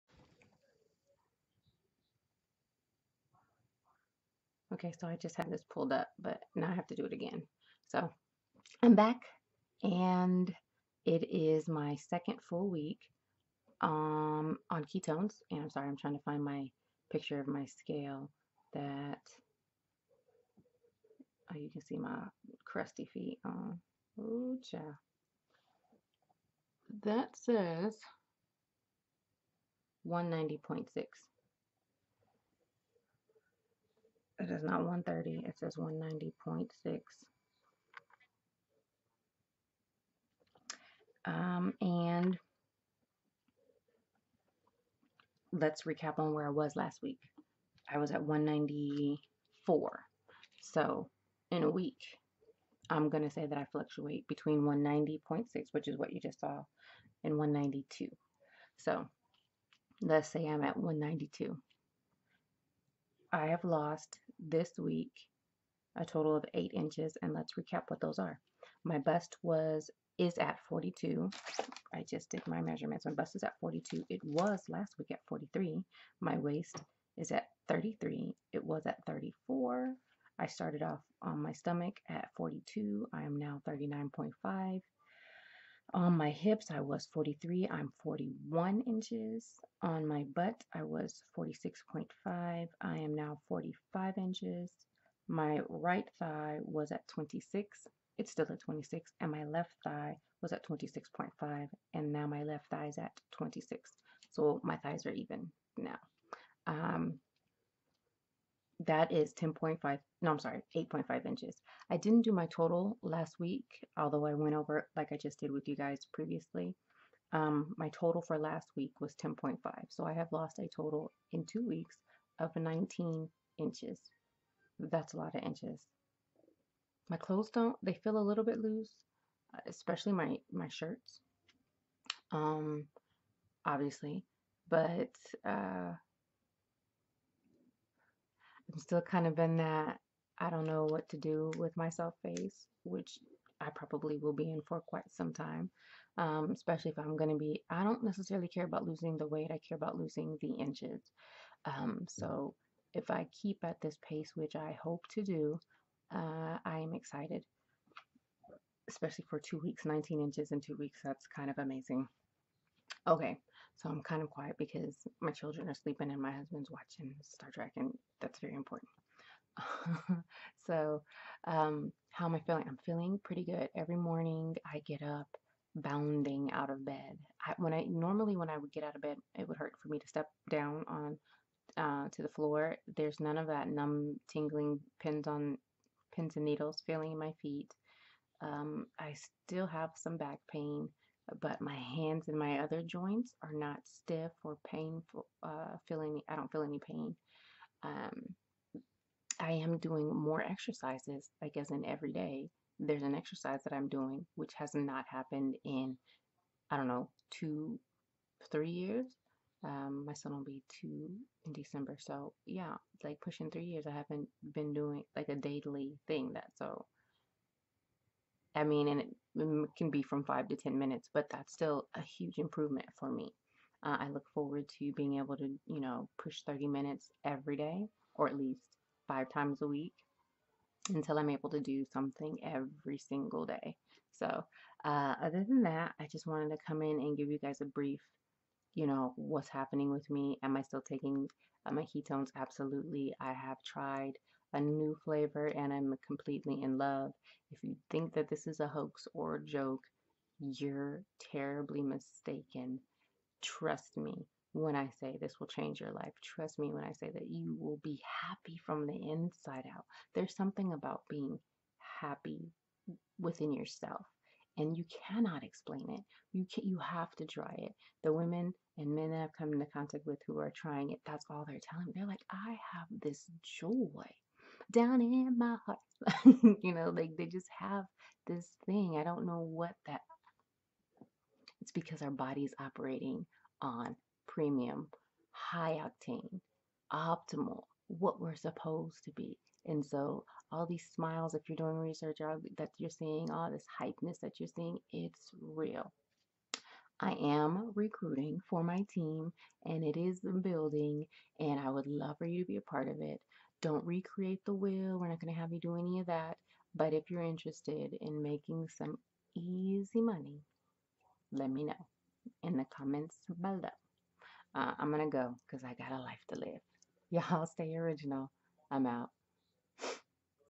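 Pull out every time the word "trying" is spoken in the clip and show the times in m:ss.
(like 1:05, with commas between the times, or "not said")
0:15, 4:30.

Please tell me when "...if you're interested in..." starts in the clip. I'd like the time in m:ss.
5:06.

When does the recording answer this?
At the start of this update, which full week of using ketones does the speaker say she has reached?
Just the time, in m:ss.
0:11.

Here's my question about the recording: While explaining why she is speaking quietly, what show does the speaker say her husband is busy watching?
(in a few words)
Star Trek.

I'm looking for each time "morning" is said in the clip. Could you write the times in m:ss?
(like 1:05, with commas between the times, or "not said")
2:53.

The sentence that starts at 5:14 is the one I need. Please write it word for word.
Uh, I'm going to go because I got a life to live.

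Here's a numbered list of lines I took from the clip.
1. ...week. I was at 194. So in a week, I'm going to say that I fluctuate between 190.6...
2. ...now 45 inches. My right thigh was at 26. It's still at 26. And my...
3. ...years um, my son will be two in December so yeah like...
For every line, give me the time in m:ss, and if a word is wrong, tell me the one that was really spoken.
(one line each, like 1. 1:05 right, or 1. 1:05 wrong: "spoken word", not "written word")
1. 0:47 right
2. 1:33 right
3. 3:28 right.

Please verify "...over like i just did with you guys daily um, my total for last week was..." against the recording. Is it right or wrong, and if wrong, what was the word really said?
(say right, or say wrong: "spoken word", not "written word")
wrong: "previously", not "daily".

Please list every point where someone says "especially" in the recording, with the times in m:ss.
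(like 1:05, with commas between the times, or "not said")
2:09, 2:26, 2:38.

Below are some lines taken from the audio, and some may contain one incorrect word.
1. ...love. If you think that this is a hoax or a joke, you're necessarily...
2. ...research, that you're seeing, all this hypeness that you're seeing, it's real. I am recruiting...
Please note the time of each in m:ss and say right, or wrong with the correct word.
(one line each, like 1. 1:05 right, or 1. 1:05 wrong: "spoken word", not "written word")
1. 4:06 wrong: "terribly", not "necessarily"
2. 4:51 right.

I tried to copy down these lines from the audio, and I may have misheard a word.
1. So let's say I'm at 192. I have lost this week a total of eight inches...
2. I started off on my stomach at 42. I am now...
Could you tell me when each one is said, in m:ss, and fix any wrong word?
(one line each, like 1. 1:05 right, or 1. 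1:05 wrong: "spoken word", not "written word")
1. 0:58 right
2. 1:20 right.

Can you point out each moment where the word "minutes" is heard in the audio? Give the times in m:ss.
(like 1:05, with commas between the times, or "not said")
3:40, 3:46.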